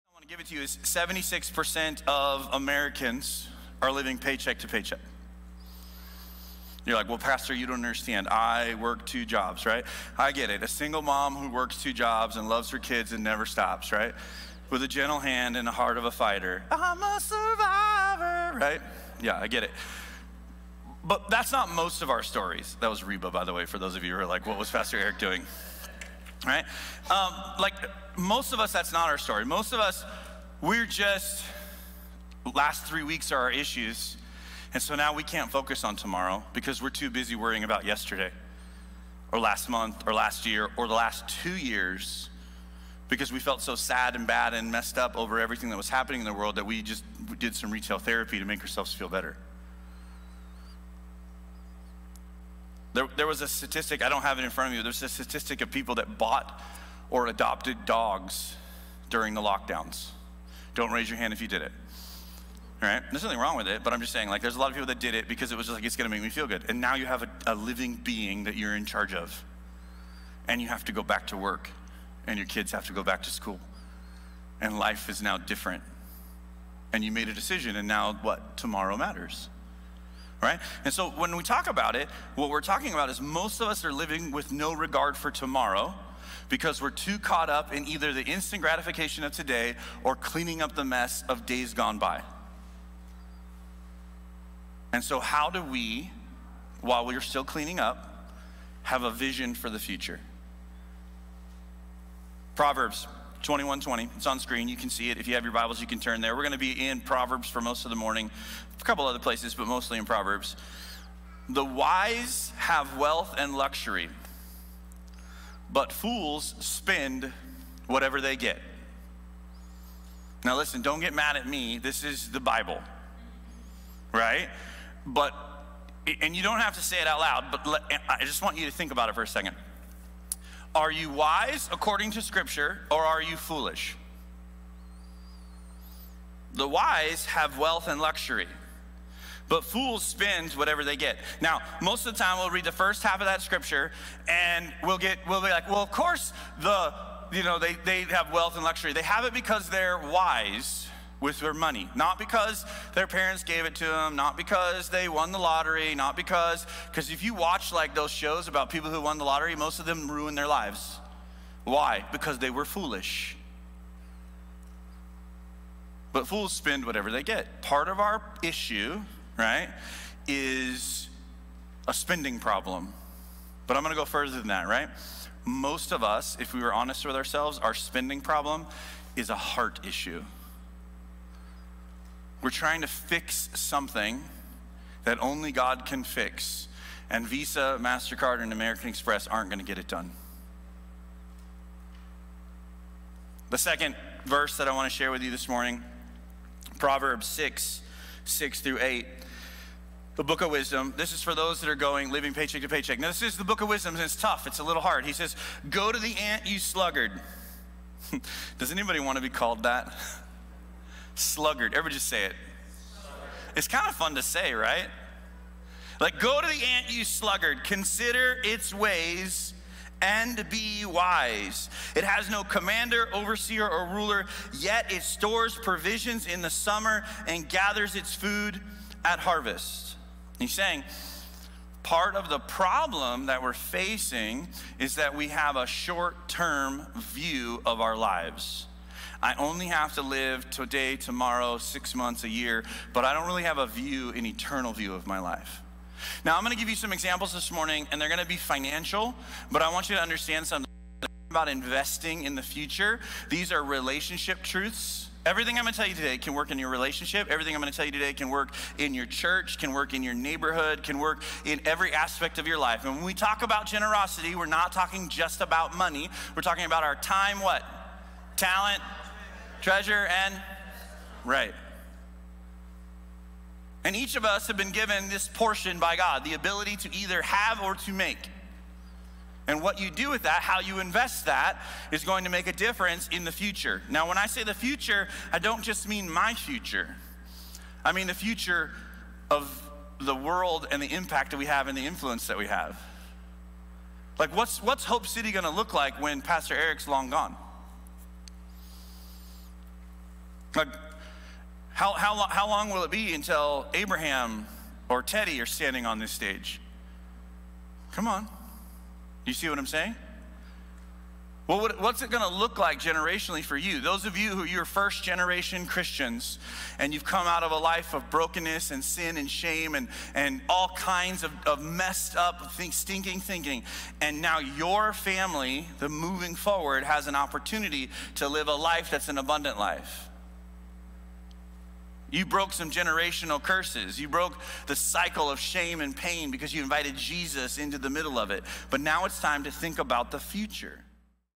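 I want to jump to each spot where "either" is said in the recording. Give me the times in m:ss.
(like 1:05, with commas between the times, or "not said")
1:27, 4:36.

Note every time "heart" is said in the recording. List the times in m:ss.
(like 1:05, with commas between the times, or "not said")
0:15, 2:59.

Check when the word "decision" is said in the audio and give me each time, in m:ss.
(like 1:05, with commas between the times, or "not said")
1:17.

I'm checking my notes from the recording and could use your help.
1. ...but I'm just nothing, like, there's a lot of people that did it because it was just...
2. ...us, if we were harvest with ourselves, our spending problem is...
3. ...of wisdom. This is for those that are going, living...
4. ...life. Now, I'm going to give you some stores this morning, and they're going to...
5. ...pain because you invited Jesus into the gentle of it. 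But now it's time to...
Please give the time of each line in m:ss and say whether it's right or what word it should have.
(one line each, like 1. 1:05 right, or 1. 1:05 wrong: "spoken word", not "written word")
1. 1:03 wrong: "saying", not "nothing"
2. 2:56 wrong: "honest", not "harvest"
3. 3:20 right
4. 4:05 wrong: "examples", not "stores"
5. 5:35 wrong: "middle", not "gentle".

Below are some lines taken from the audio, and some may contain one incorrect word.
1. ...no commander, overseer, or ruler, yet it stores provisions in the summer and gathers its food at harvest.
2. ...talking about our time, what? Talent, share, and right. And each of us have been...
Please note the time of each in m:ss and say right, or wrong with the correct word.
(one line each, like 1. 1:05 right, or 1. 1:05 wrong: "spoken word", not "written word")
1. 3:42 right
2. 4:26 wrong: "treasure", not "share".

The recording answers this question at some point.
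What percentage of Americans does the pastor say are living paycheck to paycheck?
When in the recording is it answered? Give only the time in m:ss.
0:00.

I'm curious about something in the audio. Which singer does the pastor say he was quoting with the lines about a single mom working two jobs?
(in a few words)
Reba.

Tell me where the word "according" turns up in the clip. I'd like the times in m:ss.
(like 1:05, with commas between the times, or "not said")
2:11.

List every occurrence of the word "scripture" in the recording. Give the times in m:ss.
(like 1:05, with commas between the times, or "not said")
2:12, 2:23.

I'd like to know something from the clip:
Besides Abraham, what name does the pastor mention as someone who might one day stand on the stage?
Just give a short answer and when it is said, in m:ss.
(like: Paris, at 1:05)
Teddy, at 5:05.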